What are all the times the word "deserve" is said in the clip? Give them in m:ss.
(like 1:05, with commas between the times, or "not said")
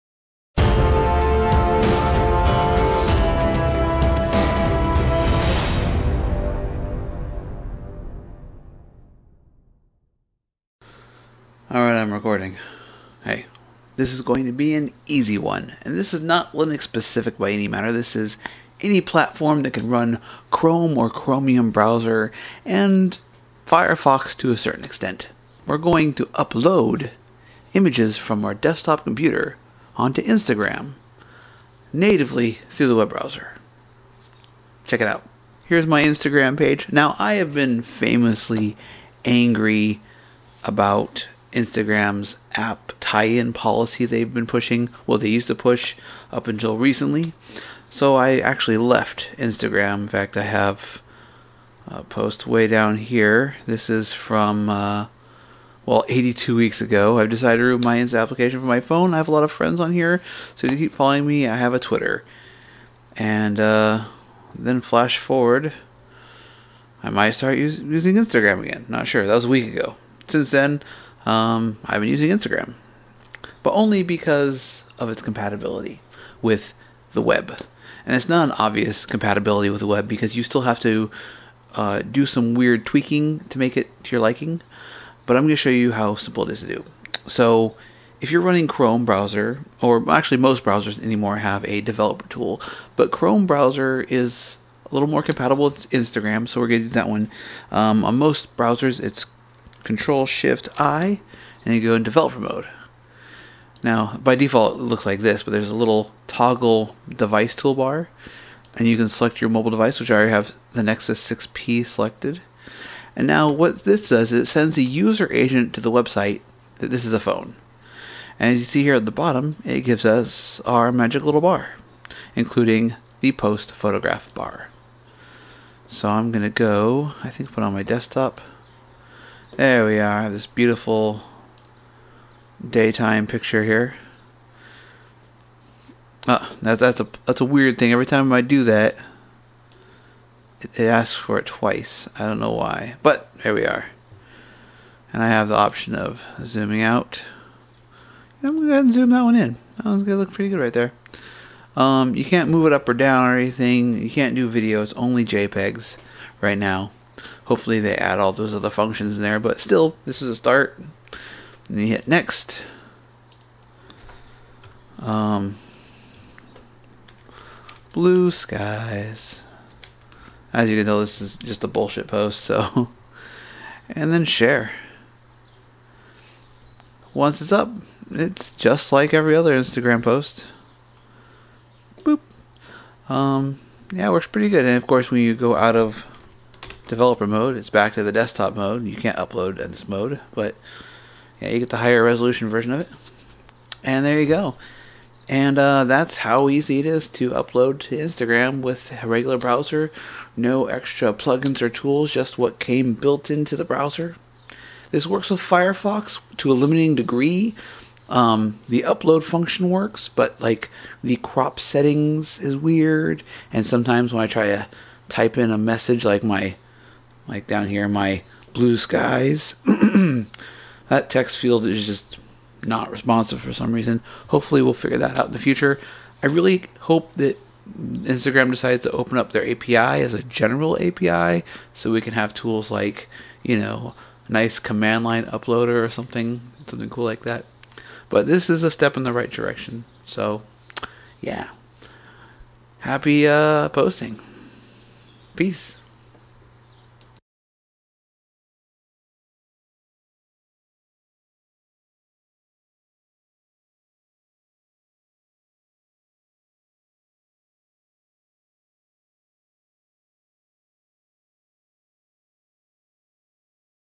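not said.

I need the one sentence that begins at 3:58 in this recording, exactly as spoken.
But this is a step in the right direction.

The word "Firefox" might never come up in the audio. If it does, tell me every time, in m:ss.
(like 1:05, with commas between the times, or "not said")
0:23, 3:25.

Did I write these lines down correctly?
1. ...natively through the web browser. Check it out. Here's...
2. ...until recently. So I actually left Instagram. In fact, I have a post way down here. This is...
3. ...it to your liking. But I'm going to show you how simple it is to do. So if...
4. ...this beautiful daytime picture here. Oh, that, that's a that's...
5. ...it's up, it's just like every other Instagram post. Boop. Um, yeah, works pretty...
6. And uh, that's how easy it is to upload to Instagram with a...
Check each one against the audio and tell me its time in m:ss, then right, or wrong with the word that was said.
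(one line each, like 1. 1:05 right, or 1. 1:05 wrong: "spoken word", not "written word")
1. 0:31 right
2. 0:46 right
3. 1:23 right
4. 2:10 right
5. 2:57 right
6. 3:15 right.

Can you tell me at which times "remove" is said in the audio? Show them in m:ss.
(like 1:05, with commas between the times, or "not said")
0:57.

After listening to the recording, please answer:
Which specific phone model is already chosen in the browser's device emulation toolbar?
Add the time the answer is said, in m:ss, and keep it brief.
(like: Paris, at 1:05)
Nexus 6P, at 1:50.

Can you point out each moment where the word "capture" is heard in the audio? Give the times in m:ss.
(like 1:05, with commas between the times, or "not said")
not said.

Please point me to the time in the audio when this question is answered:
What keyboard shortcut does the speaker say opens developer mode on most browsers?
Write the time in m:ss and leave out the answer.
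1:39.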